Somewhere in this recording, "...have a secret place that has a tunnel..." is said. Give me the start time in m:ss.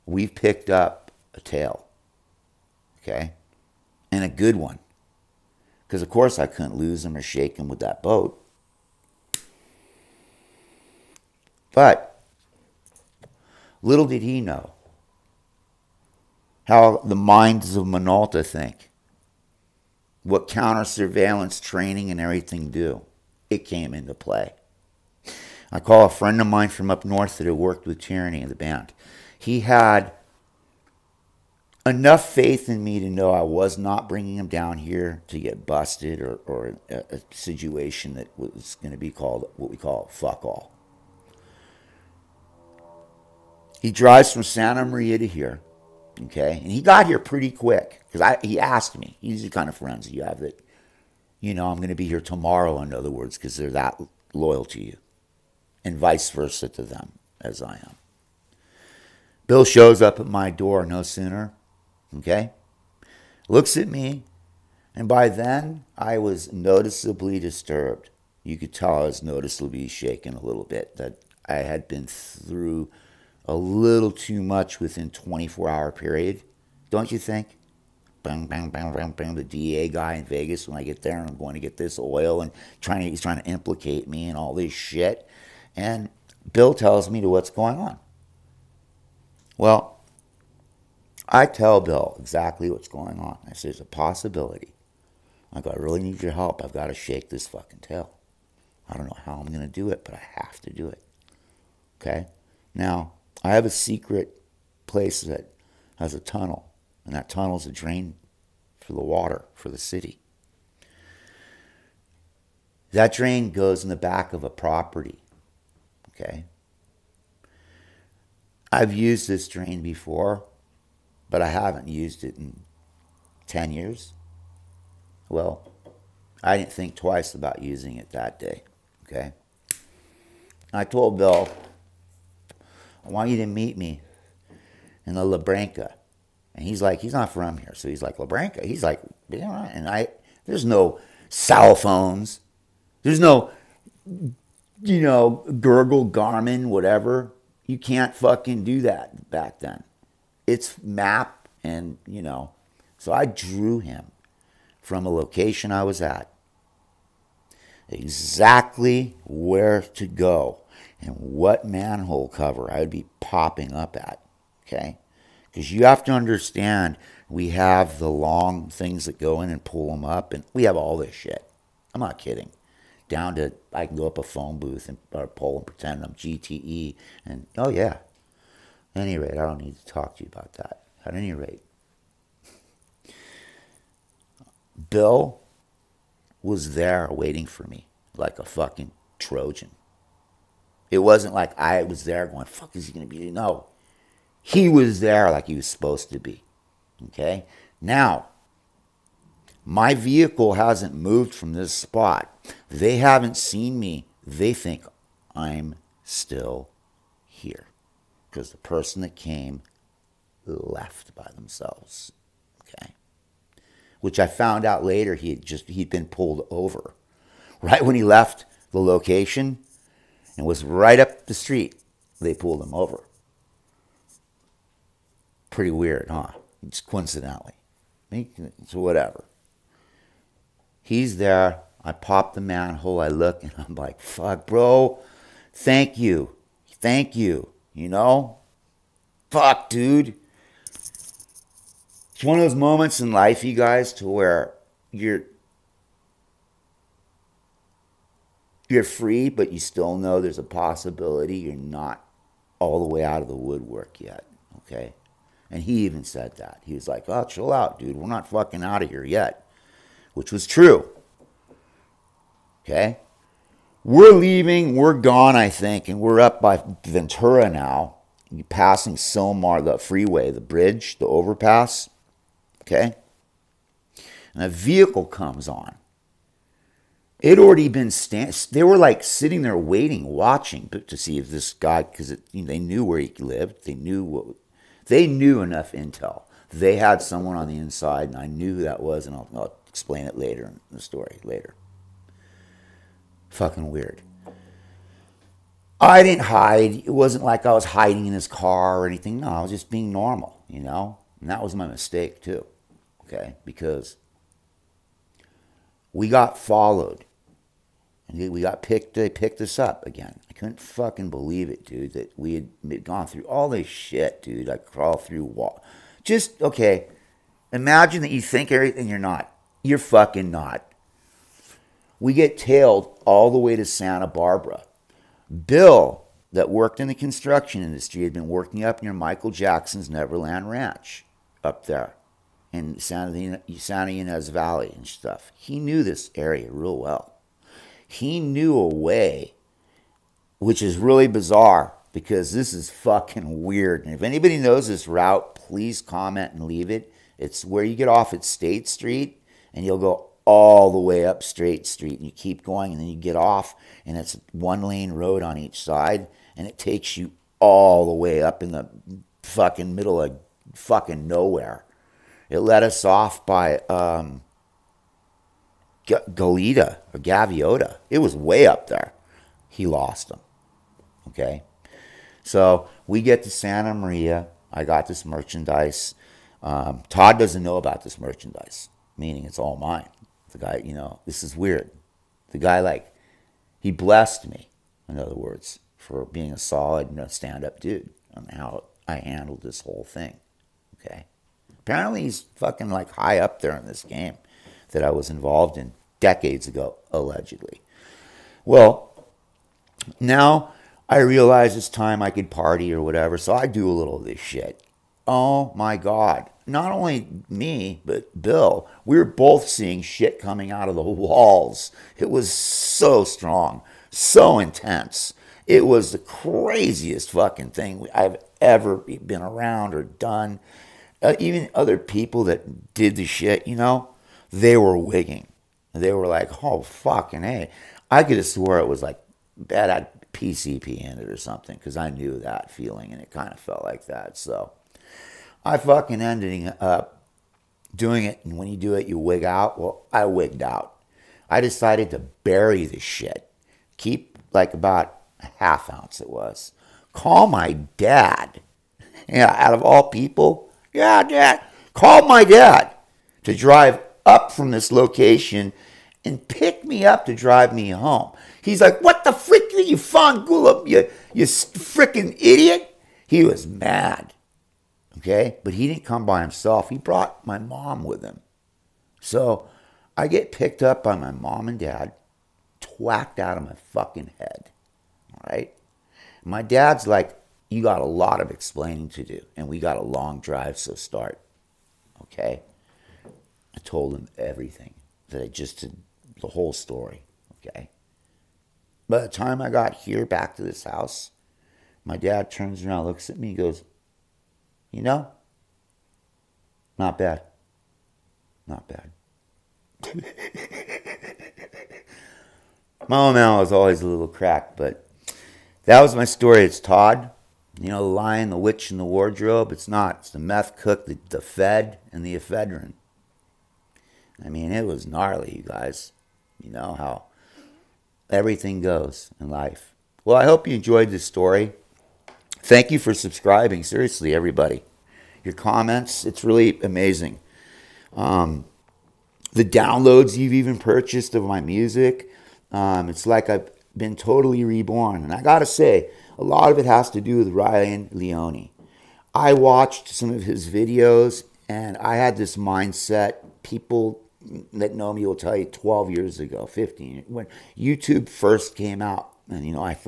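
1:43.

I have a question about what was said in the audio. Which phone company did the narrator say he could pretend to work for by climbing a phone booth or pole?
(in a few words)
GTE.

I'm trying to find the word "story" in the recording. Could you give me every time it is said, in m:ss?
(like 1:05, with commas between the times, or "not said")
4:50, 8:06, 8:26, 8:41.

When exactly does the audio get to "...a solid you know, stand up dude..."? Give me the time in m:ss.
6:26.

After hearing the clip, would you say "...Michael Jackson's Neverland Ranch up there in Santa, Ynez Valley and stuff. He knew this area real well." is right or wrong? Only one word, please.
right.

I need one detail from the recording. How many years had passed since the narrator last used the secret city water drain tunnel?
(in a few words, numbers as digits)
10.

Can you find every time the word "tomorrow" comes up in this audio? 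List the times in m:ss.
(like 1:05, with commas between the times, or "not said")
0:52.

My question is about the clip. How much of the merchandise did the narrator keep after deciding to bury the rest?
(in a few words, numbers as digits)
half ounce.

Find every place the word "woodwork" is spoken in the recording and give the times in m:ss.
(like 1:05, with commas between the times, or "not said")
4:13.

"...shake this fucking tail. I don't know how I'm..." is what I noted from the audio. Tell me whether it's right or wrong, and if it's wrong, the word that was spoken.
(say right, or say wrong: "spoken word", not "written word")
right.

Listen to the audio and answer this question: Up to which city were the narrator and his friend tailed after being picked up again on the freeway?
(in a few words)
Santa Barbara.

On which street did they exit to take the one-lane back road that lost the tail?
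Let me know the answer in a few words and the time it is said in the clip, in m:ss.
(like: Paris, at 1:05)
State Street, at 5:48.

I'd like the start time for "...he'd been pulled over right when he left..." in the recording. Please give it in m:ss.
3:35.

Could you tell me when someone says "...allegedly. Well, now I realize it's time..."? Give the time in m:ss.
6:36.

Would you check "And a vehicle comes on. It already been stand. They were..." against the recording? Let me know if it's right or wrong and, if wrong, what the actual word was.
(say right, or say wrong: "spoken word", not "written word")
right.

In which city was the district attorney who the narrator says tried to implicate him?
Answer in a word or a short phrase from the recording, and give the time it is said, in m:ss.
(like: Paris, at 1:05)
Vegas, at 1:20.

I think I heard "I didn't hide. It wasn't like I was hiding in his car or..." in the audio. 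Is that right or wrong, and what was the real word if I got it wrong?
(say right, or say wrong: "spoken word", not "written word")
right.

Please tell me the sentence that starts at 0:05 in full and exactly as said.
Because, of course, I couldn't lose him or shake him with that boat.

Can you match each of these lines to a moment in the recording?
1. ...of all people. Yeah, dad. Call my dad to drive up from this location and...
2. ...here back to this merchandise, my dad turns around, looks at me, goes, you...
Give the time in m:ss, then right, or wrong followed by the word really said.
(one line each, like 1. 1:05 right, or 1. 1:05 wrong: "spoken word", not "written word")
1. 7:29 right
2. 8:09 wrong: "house", not "merchandise".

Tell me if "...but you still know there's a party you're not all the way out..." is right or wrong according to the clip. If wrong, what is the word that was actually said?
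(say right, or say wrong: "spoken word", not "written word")
wrong: "possibility", not "party".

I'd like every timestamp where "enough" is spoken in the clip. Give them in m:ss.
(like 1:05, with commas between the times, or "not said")
0:31, 4:45.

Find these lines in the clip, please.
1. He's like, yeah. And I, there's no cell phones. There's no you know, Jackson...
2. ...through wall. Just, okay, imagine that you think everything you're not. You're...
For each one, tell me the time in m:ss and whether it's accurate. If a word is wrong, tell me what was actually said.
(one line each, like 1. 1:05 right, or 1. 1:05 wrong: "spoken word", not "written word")
1. 2:18 wrong: "Google", not "Jackson"
2. 5:15 right.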